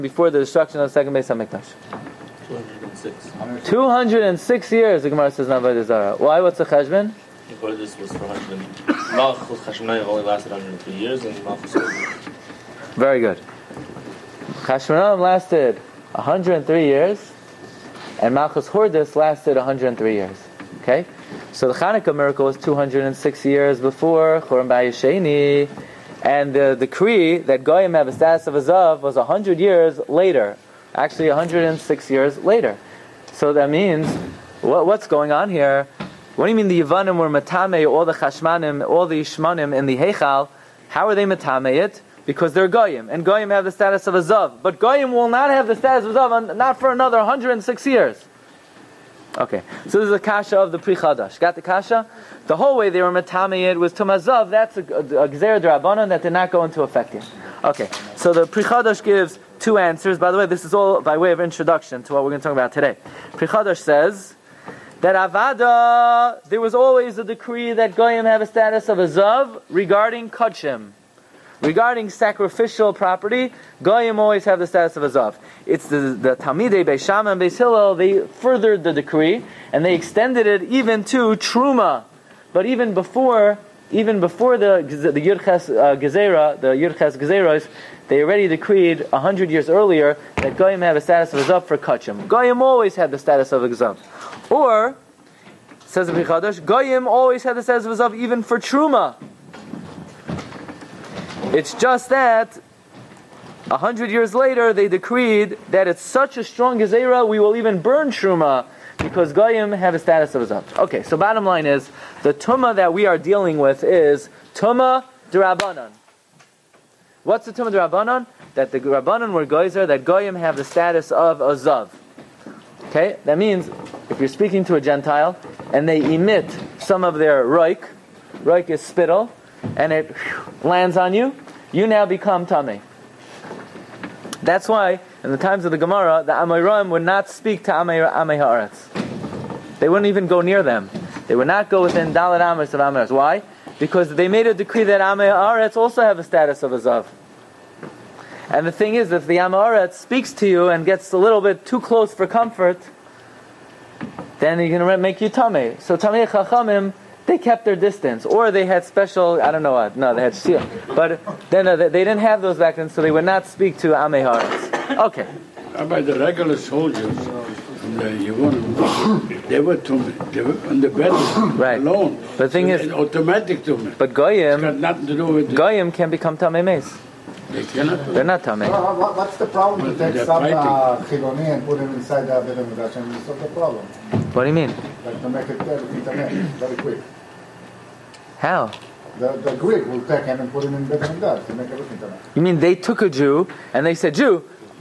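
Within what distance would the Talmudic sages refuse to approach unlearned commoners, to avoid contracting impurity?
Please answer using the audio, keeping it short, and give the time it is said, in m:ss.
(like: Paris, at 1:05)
4 amos, at 2:22.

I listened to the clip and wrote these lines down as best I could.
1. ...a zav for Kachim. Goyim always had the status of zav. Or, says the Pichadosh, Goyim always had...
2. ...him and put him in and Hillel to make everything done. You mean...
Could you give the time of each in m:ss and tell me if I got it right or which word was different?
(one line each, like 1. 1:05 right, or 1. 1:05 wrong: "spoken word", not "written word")
1. 1:31 right
2. 3:10 wrong: "HaMikdash", not "Hillel".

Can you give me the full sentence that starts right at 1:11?
Regarding sacrificial property, Goyim always have the status of a zav.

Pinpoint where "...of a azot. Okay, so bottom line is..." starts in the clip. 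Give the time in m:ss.
1:50.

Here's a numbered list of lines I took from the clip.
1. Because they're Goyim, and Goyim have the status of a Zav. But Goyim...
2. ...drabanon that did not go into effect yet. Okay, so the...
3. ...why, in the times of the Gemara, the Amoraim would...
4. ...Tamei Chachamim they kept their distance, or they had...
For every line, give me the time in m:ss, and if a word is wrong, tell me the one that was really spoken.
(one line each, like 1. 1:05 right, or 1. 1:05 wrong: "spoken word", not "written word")
1. 0:42 right
2. 0:55 right
3. 2:14 right
4. 2:35 right.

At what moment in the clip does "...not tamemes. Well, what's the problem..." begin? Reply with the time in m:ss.
2:58.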